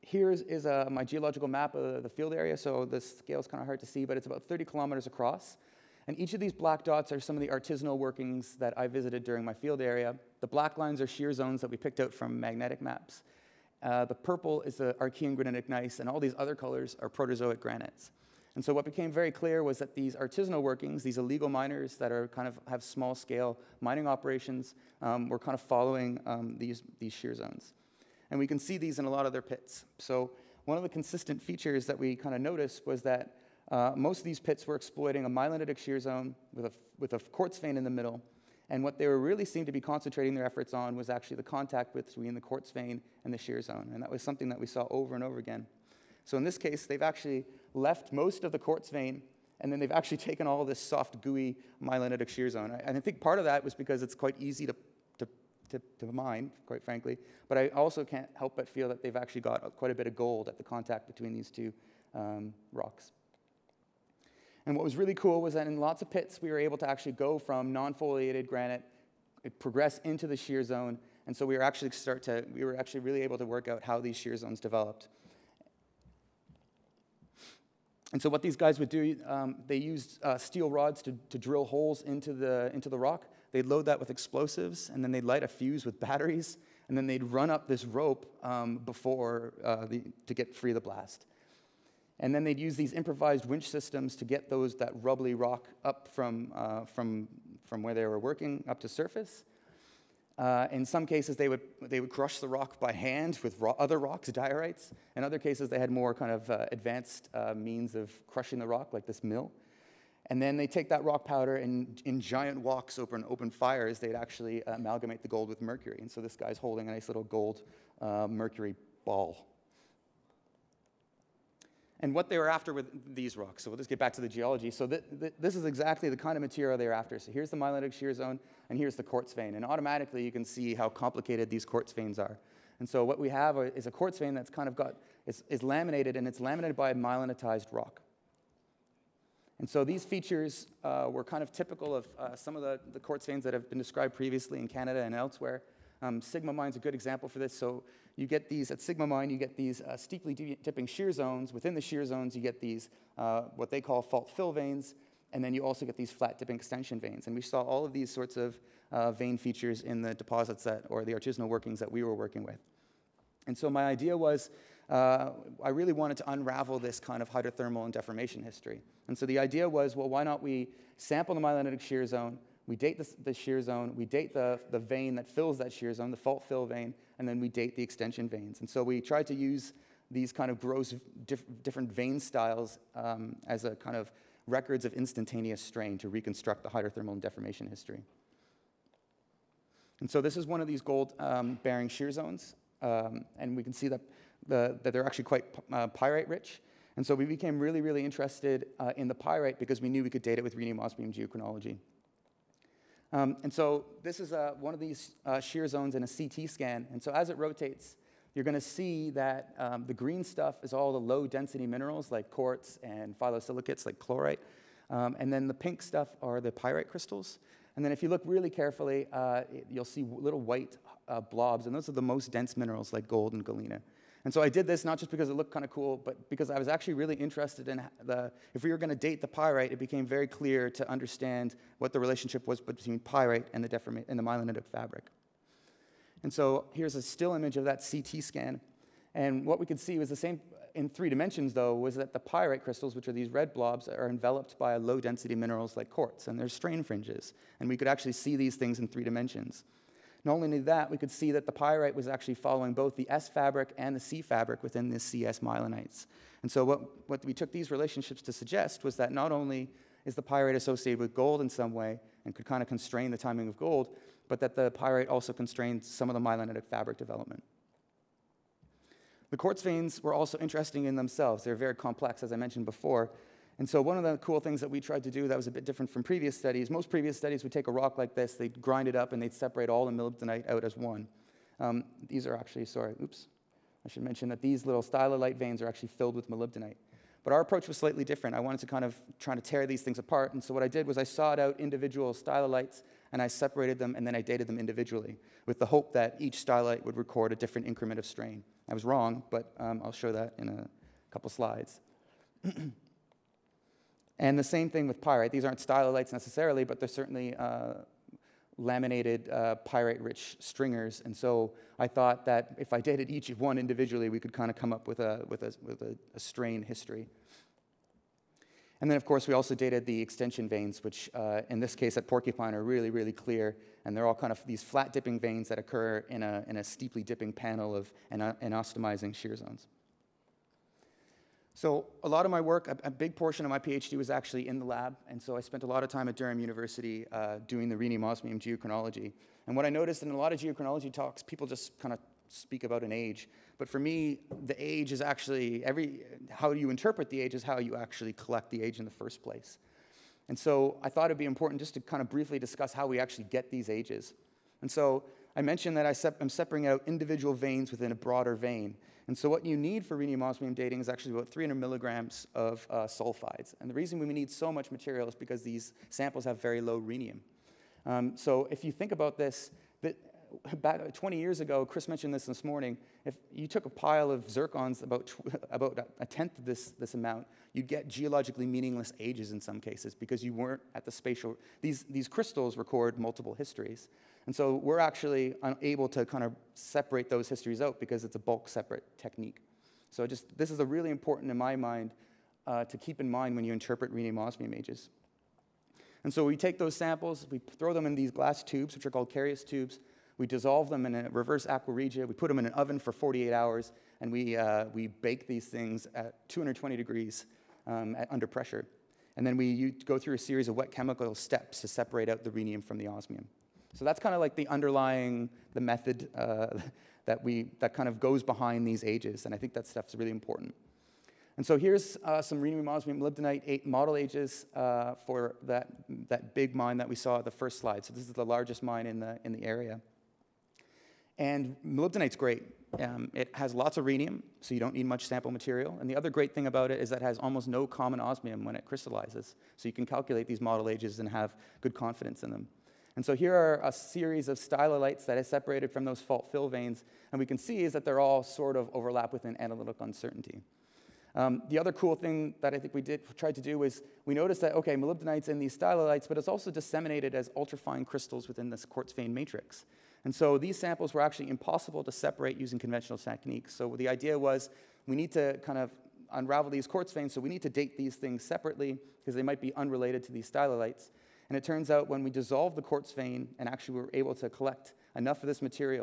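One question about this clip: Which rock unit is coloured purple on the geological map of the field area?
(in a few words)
Archean granitic gneiss.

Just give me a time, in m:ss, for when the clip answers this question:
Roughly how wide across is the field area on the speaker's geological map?
0:04.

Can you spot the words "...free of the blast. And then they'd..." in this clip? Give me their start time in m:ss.
1:30.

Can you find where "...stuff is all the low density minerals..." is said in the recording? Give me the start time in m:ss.
3:30.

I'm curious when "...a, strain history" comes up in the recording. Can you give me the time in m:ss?
5:16.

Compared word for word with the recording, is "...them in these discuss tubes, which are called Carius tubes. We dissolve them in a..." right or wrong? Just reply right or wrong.
wrong.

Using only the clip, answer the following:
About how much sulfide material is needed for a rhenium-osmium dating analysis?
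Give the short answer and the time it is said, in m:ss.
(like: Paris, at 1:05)
300 milligrams, at 6:01.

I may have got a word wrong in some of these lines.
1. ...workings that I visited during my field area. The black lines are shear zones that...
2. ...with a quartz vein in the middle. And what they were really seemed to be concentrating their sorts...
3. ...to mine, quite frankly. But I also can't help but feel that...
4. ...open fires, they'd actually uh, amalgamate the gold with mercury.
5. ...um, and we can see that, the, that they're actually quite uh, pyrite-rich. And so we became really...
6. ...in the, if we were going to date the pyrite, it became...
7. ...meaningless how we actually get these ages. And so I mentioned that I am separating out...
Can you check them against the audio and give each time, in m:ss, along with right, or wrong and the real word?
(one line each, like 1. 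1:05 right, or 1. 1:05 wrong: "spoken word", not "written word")
1. 0:07 right
2. 0:36 wrong: "efforts", not "sorts"
3. 0:55 right
4. 1:53 right
5. 3:12 right
6. 3:47 right
7. 5:52 wrong: "discuss", not "meaningless".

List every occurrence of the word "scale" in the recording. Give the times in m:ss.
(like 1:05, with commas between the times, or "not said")
0:02, 0:23.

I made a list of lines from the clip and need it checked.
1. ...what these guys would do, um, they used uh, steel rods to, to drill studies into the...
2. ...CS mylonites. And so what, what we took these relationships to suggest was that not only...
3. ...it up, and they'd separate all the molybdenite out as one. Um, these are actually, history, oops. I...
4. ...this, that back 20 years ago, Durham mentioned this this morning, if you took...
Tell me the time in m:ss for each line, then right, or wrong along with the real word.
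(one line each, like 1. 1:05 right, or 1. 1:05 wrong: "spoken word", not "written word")
1. 1:18 wrong: "holes", not "studies"
2. 4:14 right
3. 4:38 wrong: "sorry", not "history"
4. 6:09 wrong: "Chris", not "Durham".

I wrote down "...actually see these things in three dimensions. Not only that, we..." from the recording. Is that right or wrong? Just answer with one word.
right.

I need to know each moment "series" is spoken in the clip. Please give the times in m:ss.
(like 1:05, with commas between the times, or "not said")
6:50, 7:23.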